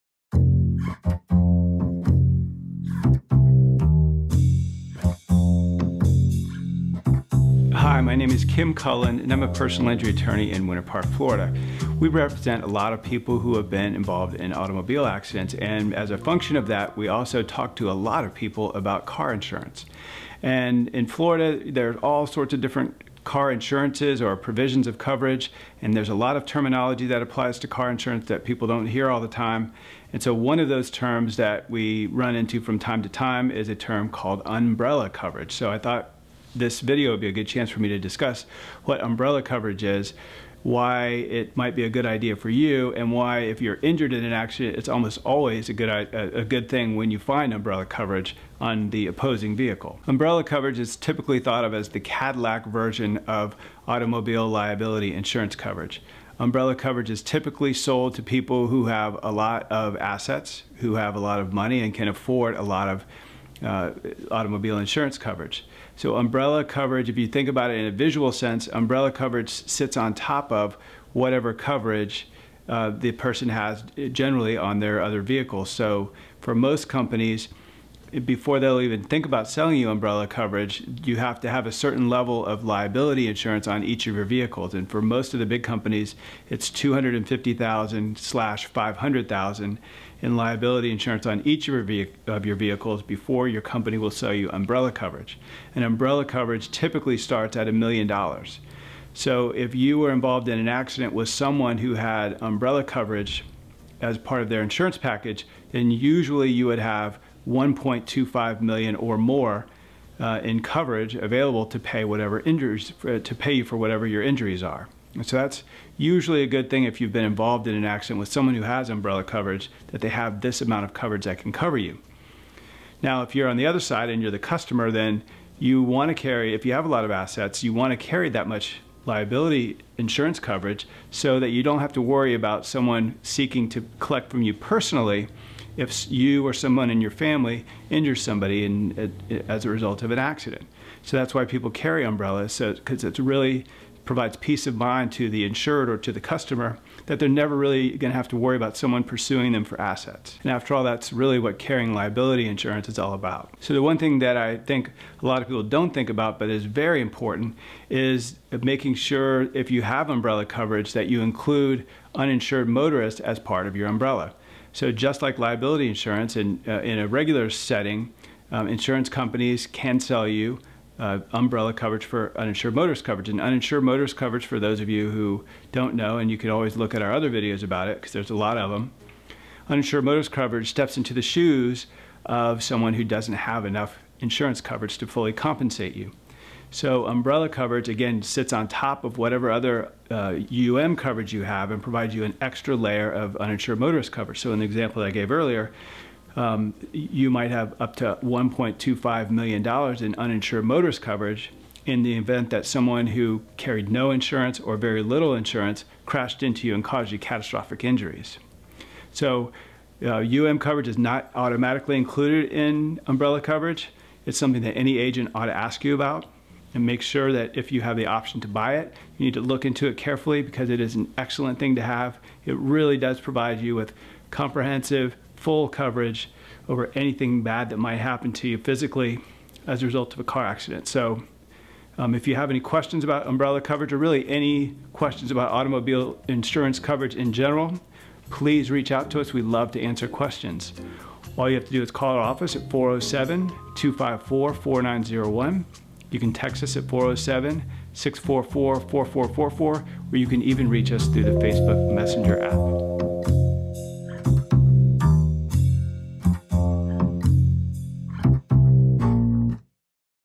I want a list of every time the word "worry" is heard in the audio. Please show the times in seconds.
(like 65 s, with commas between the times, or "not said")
132 s, 148 s.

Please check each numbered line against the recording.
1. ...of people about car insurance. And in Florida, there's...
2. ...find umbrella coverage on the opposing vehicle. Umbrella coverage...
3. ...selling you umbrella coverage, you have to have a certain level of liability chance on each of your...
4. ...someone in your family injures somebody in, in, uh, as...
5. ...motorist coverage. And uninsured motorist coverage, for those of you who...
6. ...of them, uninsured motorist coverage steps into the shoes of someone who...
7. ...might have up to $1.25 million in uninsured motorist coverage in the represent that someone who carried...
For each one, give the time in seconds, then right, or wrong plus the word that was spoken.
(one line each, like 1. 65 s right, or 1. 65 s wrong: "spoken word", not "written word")
1. 18 s right
2. 47 s right
3. 79 s wrong: "insurance", not "chance"
4. 136 s right
5. 172 s right
6. 178 s right
7. 197 s wrong: "event", not "represent".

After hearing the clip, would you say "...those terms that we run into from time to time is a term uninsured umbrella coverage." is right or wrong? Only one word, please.
wrong.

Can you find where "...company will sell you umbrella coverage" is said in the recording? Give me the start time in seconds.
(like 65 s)
93 s.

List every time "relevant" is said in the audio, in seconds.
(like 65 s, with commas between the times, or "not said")
not said.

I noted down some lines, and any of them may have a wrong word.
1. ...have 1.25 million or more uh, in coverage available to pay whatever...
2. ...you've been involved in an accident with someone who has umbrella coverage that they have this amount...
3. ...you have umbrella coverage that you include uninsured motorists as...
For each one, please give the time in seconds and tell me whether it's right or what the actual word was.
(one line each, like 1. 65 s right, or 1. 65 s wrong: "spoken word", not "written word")
1. 106 s right
2. 117 s right
3. 159 s right.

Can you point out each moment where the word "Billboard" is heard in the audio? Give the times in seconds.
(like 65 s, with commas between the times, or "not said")
not said.